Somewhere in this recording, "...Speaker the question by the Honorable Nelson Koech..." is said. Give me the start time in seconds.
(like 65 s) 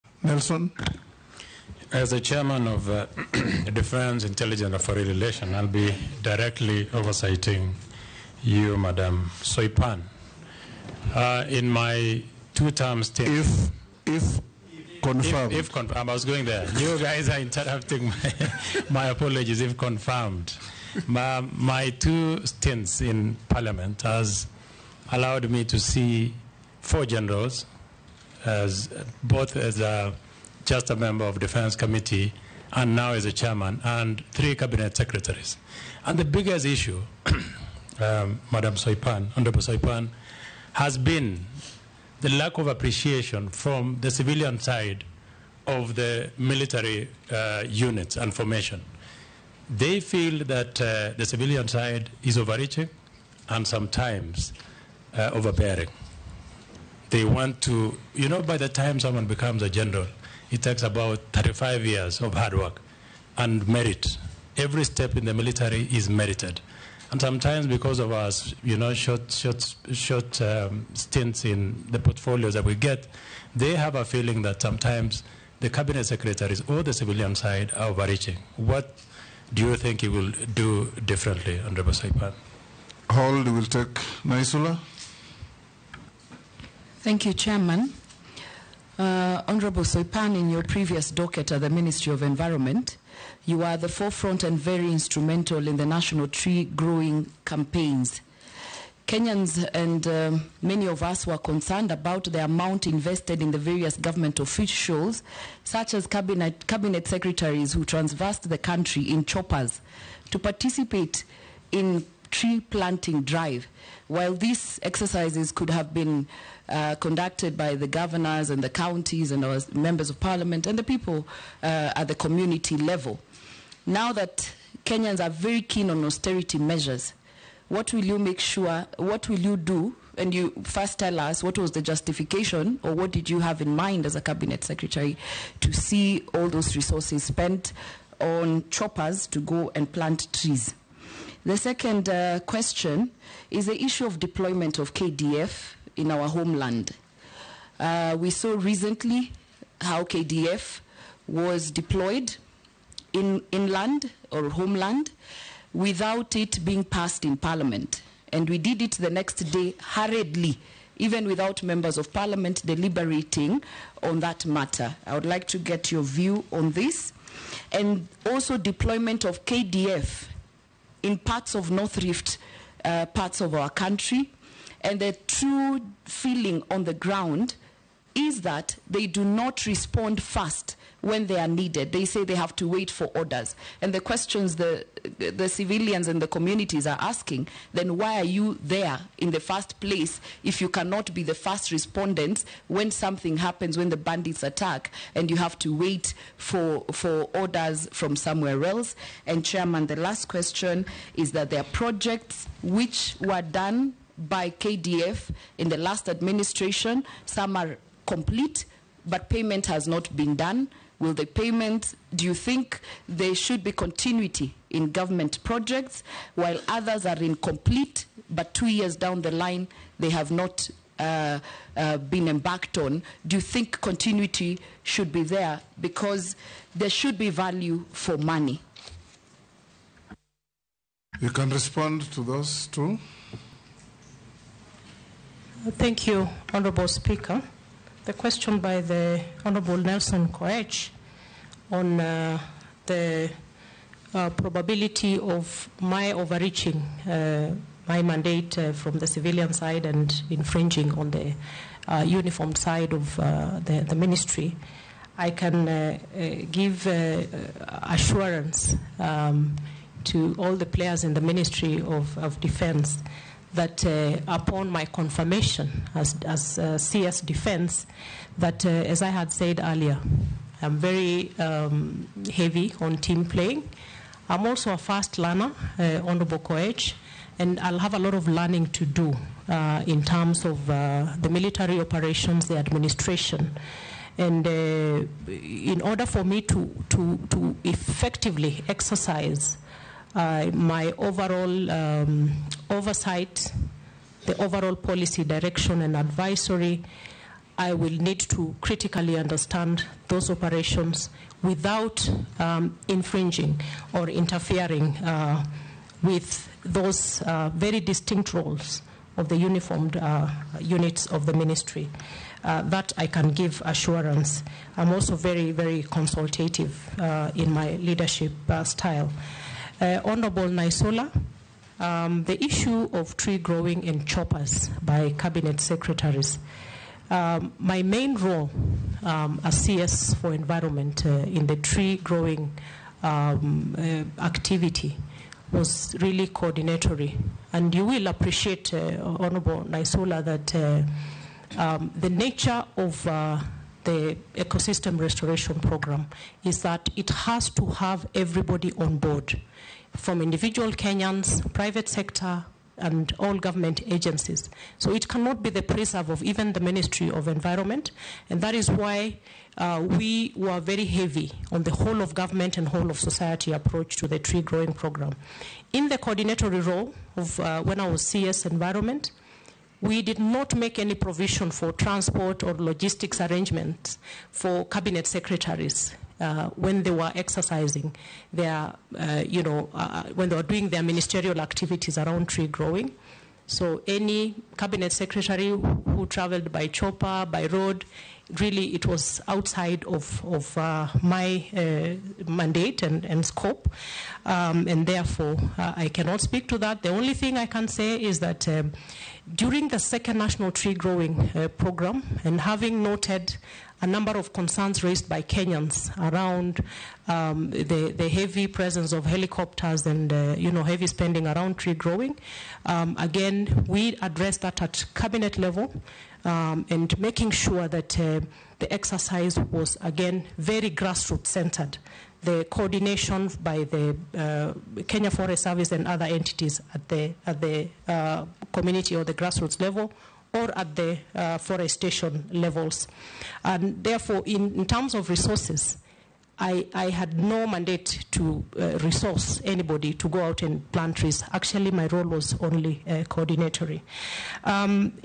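236 s.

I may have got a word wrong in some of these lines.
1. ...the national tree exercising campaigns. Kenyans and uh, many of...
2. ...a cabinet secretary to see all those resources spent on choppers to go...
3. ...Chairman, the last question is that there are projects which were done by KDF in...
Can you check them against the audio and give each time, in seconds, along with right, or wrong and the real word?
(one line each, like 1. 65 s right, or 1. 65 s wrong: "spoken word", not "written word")
1. 95 s wrong: "growing", not "exercising"
2. 134 s right
3. 199 s right.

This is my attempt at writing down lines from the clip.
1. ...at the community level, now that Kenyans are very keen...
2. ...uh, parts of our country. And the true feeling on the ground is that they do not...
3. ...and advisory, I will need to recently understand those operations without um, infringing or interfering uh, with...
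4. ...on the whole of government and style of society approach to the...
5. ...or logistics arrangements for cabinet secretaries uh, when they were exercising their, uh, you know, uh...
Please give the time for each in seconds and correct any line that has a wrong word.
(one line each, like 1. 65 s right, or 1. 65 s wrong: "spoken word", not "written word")
1. 121 s right
2. 172 s right
3. 295 s wrong: "critically", not "recently"
4. 361 s wrong: "whole", not "style"
5. 372 s right.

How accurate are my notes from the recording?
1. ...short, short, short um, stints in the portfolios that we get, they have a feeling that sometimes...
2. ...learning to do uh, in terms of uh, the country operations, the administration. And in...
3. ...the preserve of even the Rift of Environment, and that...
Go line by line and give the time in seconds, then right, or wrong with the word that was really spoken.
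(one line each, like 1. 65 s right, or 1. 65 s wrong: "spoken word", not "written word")
1. 68 s right
2. 278 s wrong: "military", not "country"
3. 355 s wrong: "Ministry", not "Rift".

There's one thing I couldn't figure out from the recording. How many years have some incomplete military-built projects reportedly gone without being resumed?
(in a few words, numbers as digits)
2 years.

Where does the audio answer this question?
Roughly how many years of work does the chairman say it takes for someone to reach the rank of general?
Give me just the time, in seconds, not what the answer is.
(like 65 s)
61 s.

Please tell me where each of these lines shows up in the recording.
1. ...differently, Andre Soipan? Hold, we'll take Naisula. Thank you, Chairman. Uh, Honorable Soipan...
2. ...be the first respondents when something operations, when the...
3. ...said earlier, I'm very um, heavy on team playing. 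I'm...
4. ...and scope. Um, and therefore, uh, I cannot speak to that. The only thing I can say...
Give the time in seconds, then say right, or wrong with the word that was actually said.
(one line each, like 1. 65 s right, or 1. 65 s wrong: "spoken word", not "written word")
1. 81 s right
2. 191 s wrong: "happens", not "operations"
3. 269 s right
4. 393 s right.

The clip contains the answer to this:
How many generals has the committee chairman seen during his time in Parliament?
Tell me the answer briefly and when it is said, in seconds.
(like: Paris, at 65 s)
4, at 26 s.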